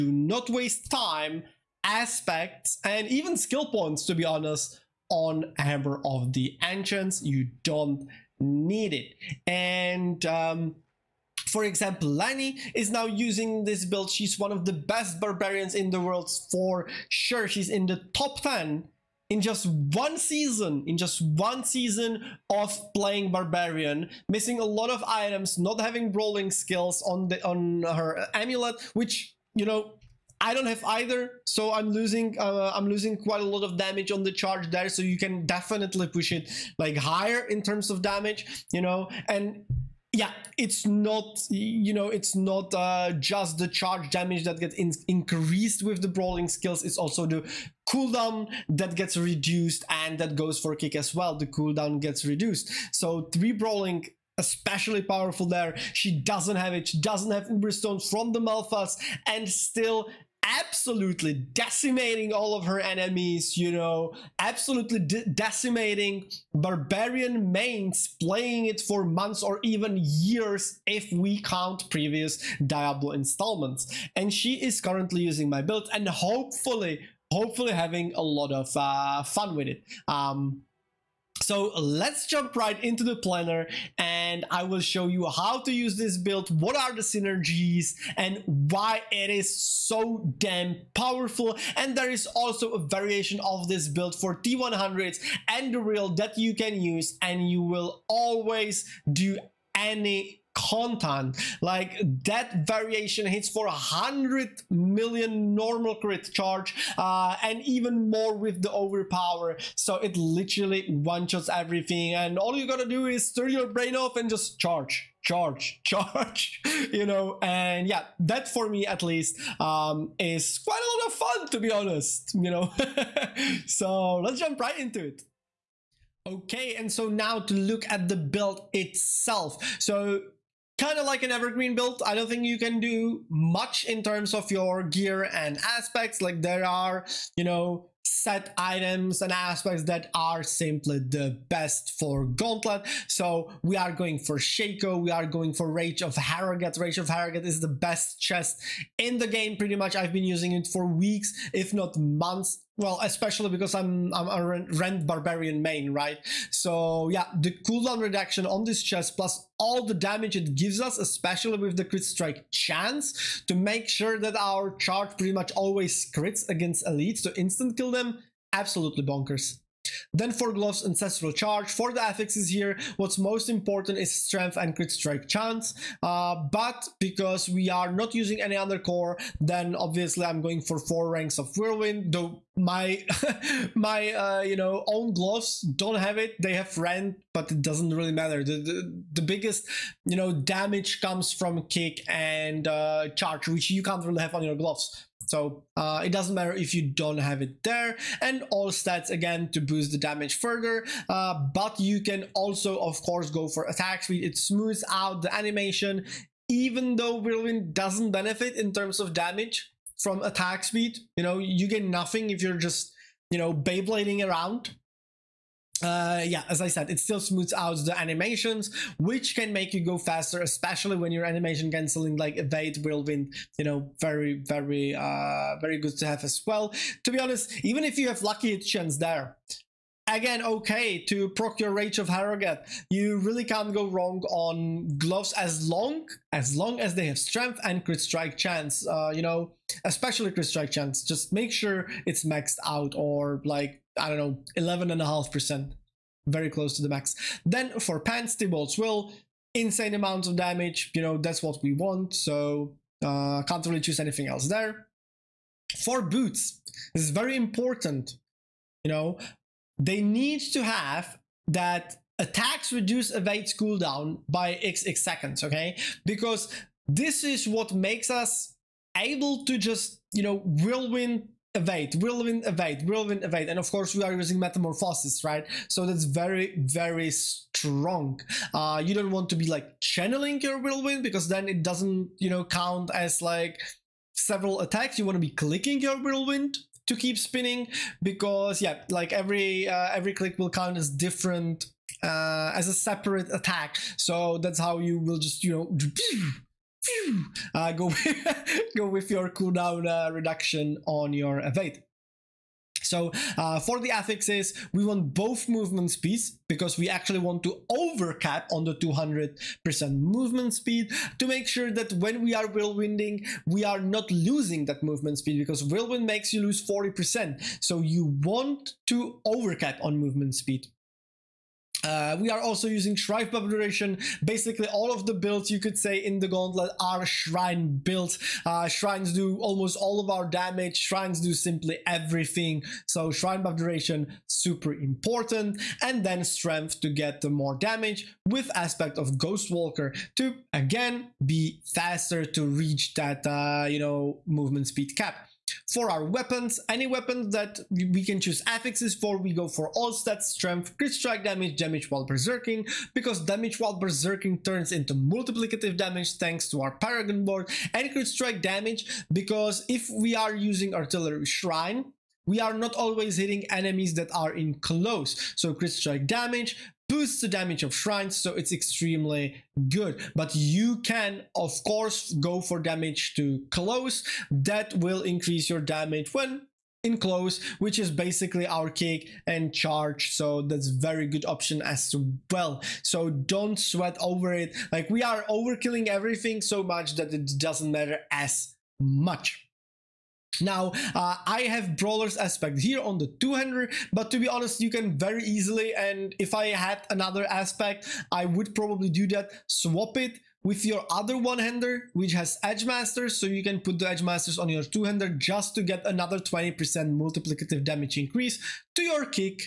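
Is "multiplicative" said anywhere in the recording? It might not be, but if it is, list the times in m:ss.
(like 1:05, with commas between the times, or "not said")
5:54, 6:46.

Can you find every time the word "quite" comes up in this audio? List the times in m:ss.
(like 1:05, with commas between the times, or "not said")
0:33, 2:00.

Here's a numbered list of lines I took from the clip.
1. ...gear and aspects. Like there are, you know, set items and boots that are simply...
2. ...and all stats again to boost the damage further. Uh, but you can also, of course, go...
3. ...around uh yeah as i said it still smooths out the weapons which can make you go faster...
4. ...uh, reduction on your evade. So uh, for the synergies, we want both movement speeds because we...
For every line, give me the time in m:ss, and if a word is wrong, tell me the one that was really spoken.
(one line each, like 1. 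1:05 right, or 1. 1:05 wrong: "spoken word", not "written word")
1. 2:14 wrong: "aspects", not "boots"
2. 3:18 right
3. 3:34 wrong: "animations", not "weapons"
4. 4:59 wrong: "affixes", not "synergies".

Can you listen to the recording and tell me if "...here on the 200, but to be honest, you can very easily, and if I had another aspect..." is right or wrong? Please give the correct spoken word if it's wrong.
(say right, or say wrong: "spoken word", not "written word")
right.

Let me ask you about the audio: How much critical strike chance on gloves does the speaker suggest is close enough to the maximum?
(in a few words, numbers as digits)
11.5%.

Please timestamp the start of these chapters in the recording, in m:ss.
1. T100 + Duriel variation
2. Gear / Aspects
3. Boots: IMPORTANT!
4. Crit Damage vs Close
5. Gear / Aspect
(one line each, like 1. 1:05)
1. 1:30
2. 2:04
3. 4:14
4. 5:44
5. 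6:29.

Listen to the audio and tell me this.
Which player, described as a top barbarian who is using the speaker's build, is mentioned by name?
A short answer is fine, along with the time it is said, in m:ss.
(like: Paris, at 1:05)
Lani, at 0:12.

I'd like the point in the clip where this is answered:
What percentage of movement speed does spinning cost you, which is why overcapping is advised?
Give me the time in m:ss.
5:16.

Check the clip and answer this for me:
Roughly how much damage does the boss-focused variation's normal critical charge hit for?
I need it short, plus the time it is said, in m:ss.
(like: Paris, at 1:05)
100 million, at 1:43.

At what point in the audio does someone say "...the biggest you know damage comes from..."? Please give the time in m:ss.
3:09.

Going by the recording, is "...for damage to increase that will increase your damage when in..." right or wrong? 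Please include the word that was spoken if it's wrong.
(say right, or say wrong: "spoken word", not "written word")
wrong: "close", not "increase".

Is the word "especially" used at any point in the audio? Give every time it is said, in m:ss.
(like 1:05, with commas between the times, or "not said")
0:54, 2:33, 2:40, 3:40, 3:59.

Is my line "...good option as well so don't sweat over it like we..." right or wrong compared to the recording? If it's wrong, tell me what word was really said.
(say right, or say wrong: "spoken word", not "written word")
right.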